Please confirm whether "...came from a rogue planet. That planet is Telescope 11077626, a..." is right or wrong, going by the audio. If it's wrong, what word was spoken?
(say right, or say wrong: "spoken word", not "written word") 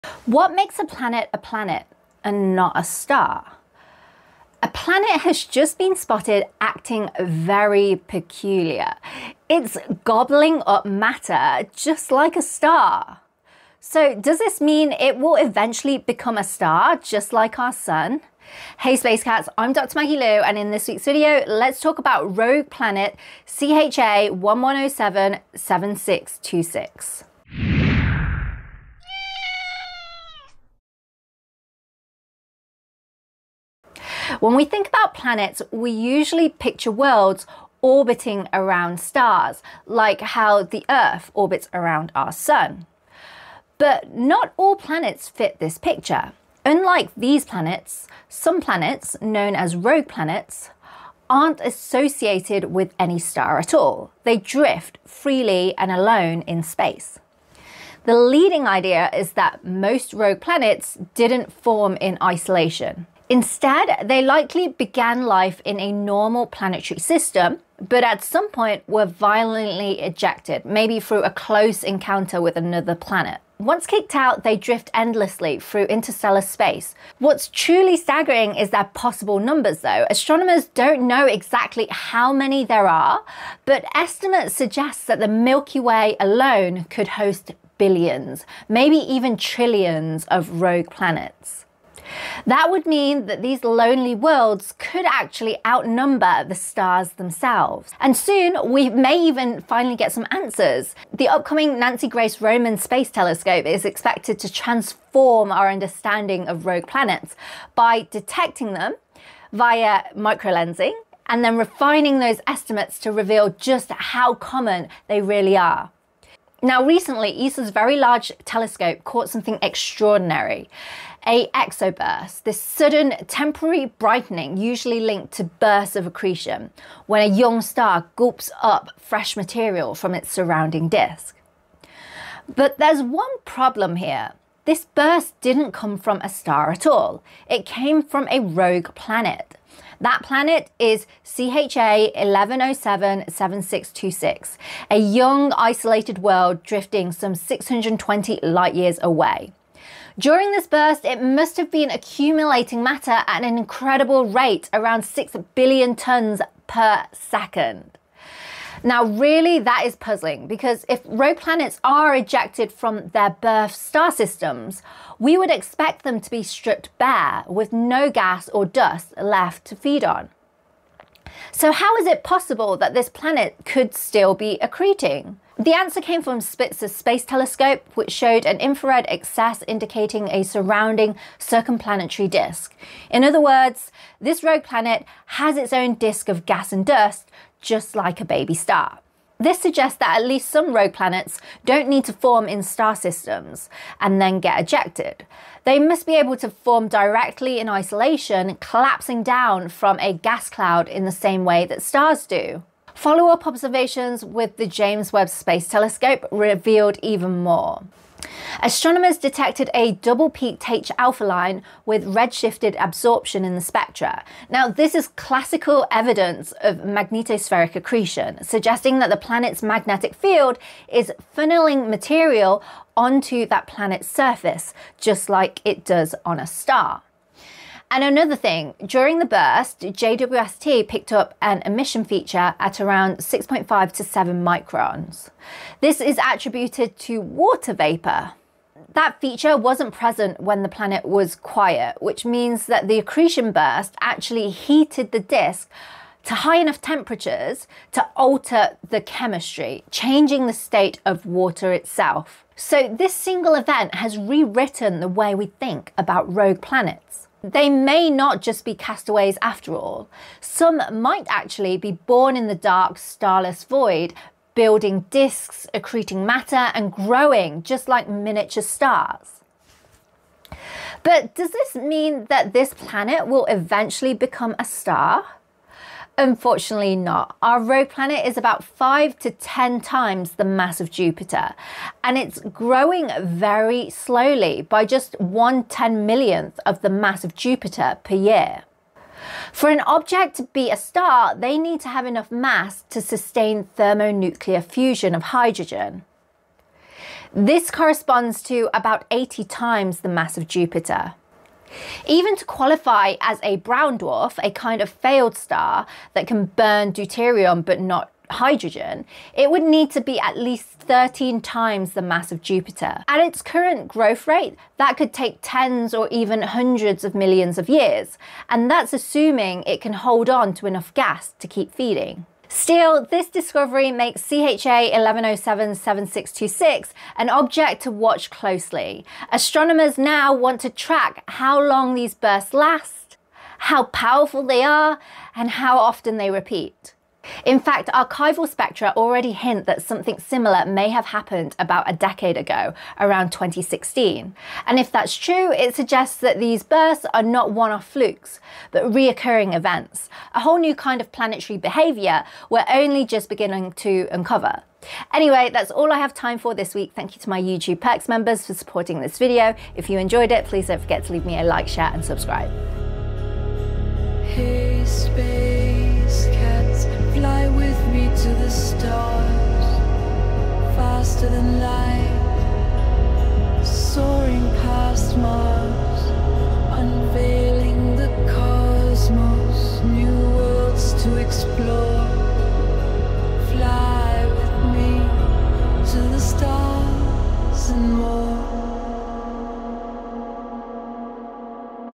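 wrong: "CHA", not "Telescope".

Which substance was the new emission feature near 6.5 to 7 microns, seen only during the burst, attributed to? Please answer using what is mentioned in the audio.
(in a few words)
Water vapour.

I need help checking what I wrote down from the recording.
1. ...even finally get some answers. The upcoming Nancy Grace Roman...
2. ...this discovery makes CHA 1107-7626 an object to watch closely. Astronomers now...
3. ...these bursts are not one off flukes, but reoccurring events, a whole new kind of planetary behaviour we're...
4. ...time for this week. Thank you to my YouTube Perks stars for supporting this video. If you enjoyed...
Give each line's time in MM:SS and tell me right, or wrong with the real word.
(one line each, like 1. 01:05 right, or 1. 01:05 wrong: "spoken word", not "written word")
1. 01:39 right
2. 05:23 right
3. 05:46 right
4. 05:56 wrong: "members", not "stars".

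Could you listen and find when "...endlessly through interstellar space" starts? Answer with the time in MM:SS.
01:14.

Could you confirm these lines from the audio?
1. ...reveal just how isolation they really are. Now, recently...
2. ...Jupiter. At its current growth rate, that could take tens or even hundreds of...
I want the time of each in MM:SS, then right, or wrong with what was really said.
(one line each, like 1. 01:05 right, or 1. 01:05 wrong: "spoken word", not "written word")
1. 01:53 wrong: "common", not "isolation"
2. 05:12 right.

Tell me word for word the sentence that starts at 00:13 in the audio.
So, does this mean it will eventually become a star just like our sun?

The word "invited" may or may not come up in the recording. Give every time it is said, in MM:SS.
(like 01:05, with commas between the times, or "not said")
not said.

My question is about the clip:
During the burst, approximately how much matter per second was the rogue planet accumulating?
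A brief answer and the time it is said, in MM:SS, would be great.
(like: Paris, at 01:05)
6 billion tons, at 02:35.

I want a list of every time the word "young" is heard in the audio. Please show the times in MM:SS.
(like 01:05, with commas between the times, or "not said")
02:07, 02:24.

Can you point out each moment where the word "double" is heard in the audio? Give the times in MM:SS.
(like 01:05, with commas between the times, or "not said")
03:29.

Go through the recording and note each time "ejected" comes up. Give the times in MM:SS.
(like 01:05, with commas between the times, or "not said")
01:10, 02:42, 03:14.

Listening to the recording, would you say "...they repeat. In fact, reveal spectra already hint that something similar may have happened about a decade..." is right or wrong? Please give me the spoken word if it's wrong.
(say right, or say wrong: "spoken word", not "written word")
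wrong: "archival", not "reveal".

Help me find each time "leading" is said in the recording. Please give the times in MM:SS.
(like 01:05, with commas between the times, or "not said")
00:58.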